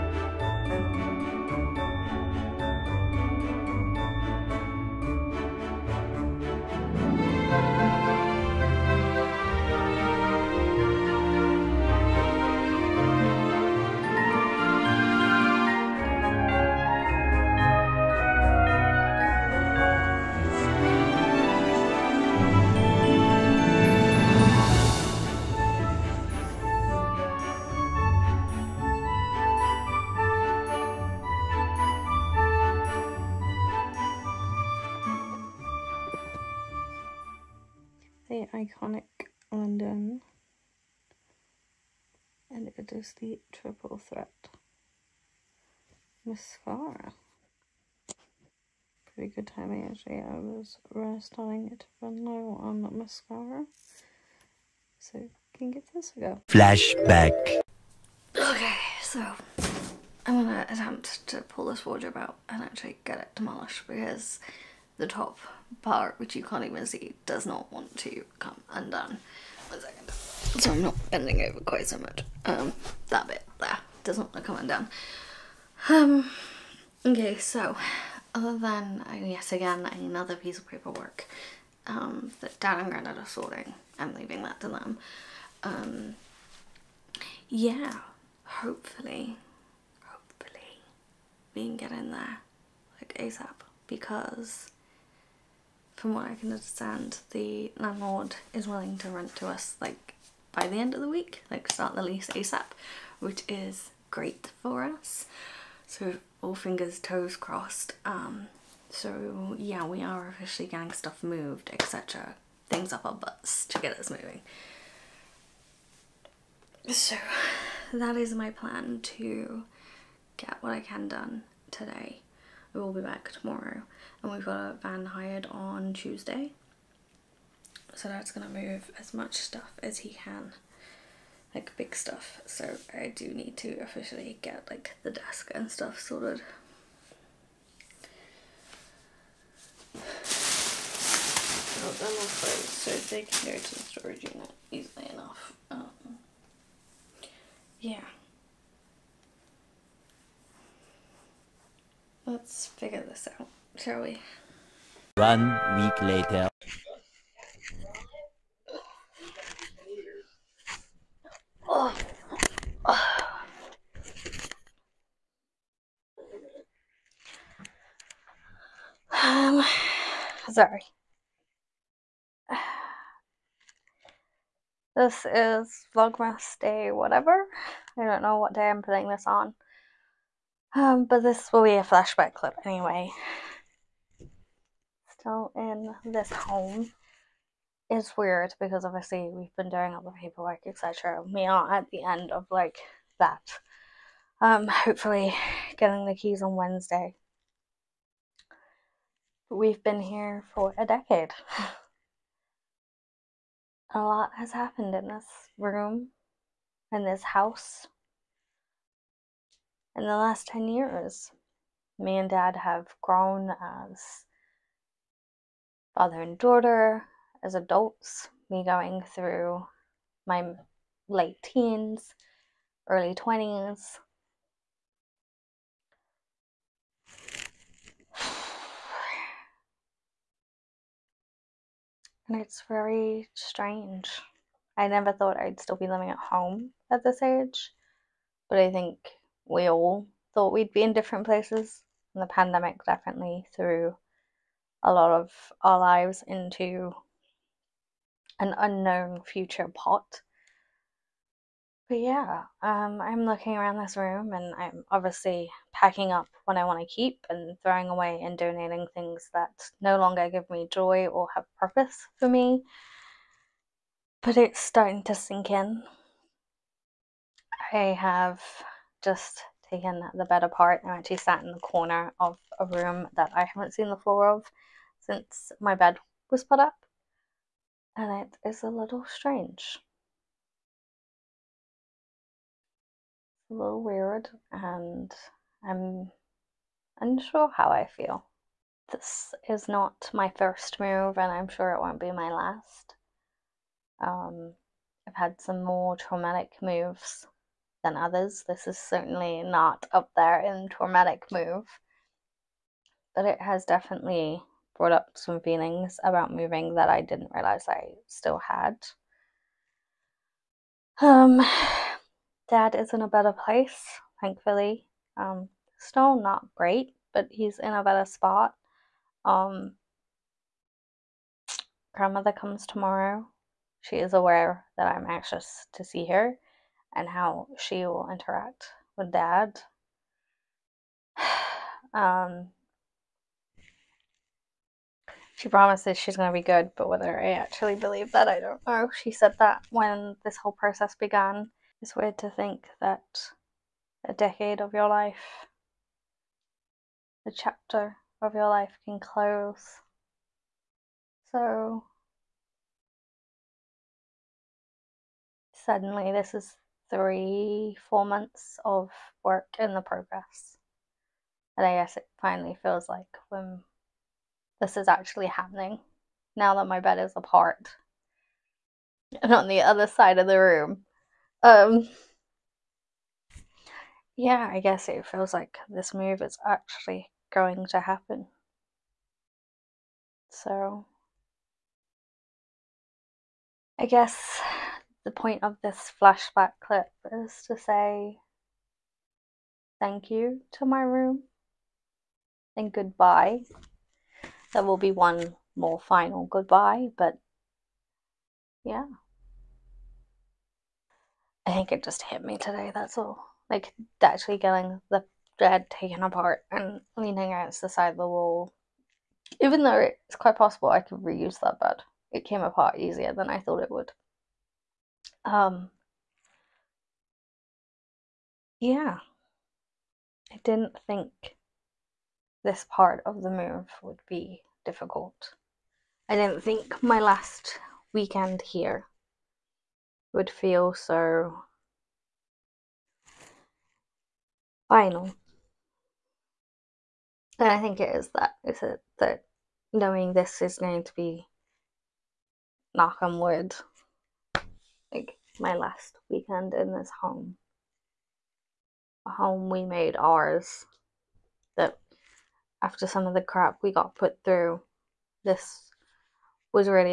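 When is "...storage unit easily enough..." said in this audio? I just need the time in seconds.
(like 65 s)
143 s.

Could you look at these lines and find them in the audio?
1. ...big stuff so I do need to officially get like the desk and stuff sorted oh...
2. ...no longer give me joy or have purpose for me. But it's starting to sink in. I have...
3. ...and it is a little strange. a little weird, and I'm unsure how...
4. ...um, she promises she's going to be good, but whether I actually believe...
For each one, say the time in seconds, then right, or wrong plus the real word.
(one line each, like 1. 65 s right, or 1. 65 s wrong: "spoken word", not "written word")
1. 131 s right
2. 259 s right
3. 277 s right
4. 331 s right.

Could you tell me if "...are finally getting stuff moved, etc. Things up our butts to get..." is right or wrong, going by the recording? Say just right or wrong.
wrong.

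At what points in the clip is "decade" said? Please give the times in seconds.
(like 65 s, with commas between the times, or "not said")
200 s, 344 s.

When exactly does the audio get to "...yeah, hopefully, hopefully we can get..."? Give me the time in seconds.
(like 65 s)
87 s.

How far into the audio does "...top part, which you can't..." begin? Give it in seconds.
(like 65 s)
65 s.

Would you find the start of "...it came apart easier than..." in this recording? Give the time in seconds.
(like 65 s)
412 s.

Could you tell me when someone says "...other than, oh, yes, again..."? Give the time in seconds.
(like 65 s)
78 s.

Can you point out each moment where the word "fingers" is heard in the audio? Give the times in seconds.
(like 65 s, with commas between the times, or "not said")
106 s.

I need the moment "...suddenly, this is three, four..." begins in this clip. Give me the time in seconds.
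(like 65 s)
355 s.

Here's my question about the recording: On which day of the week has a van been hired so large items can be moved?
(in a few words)
Tuesday.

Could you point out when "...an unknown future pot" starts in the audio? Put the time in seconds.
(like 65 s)
248 s.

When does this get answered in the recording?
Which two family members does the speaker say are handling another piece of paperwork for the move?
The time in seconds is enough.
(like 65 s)
82 s.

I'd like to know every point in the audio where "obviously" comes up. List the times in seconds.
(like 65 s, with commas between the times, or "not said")
188 s, 254 s.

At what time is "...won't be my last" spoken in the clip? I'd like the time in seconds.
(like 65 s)
291 s.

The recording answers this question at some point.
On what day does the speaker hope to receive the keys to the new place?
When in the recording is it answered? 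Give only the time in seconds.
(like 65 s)
196 s.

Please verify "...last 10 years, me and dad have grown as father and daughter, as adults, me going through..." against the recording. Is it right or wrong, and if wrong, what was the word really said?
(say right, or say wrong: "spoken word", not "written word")
right.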